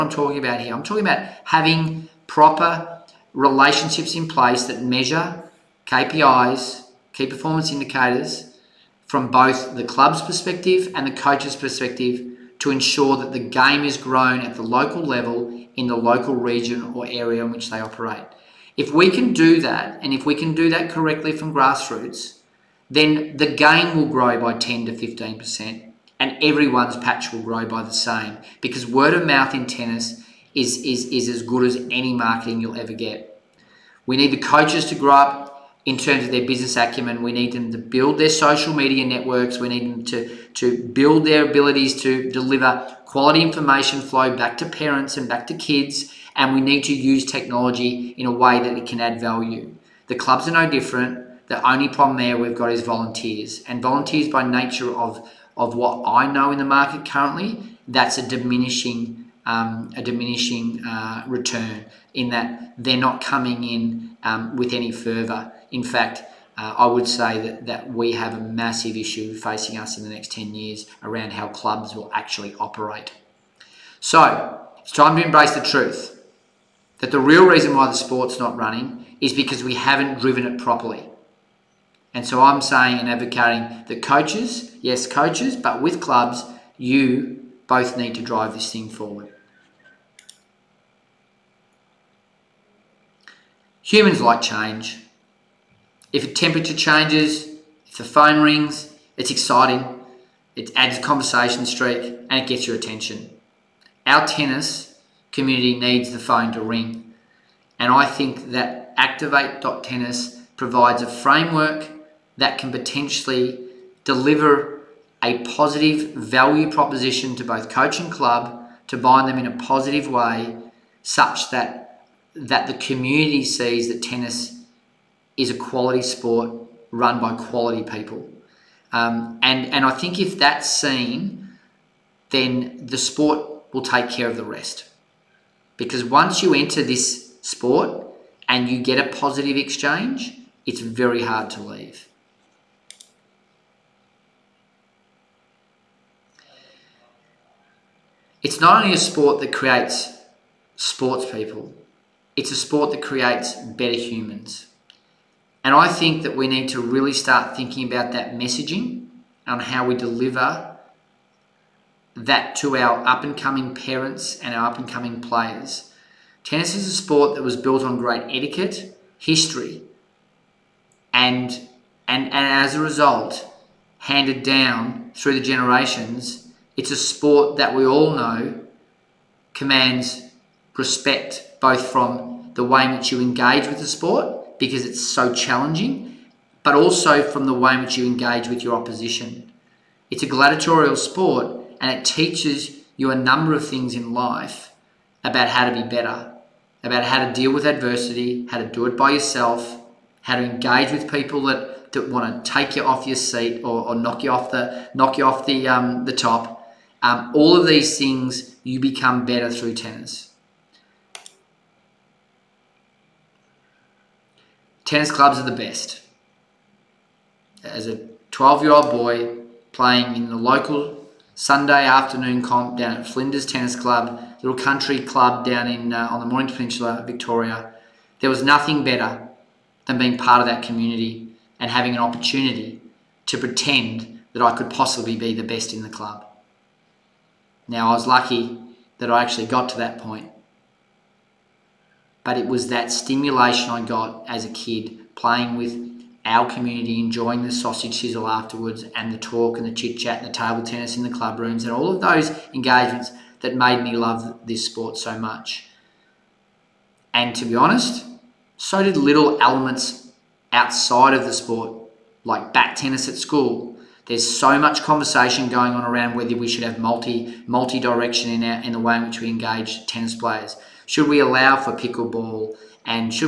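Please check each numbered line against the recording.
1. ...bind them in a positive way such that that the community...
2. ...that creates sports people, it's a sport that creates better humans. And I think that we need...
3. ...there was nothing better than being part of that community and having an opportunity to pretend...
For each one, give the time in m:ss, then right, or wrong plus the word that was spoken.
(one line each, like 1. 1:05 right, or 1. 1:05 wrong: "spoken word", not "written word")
1. 1:58 right
2. 2:29 right
3. 3:48 right.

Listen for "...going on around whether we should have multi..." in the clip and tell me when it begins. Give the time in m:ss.
4:25.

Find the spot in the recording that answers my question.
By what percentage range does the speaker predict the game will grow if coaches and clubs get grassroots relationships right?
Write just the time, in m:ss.
0:24.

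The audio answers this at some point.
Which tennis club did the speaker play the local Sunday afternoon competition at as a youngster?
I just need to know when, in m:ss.
3:43.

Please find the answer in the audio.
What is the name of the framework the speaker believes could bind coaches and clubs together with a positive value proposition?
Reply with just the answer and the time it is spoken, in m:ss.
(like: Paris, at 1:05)
activate.tennis, at 1:48.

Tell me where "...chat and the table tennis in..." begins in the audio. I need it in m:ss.
4:09.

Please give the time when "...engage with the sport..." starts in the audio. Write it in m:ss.
3:03.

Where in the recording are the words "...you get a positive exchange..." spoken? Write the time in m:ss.
2:18.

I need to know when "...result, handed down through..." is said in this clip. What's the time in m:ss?
2:52.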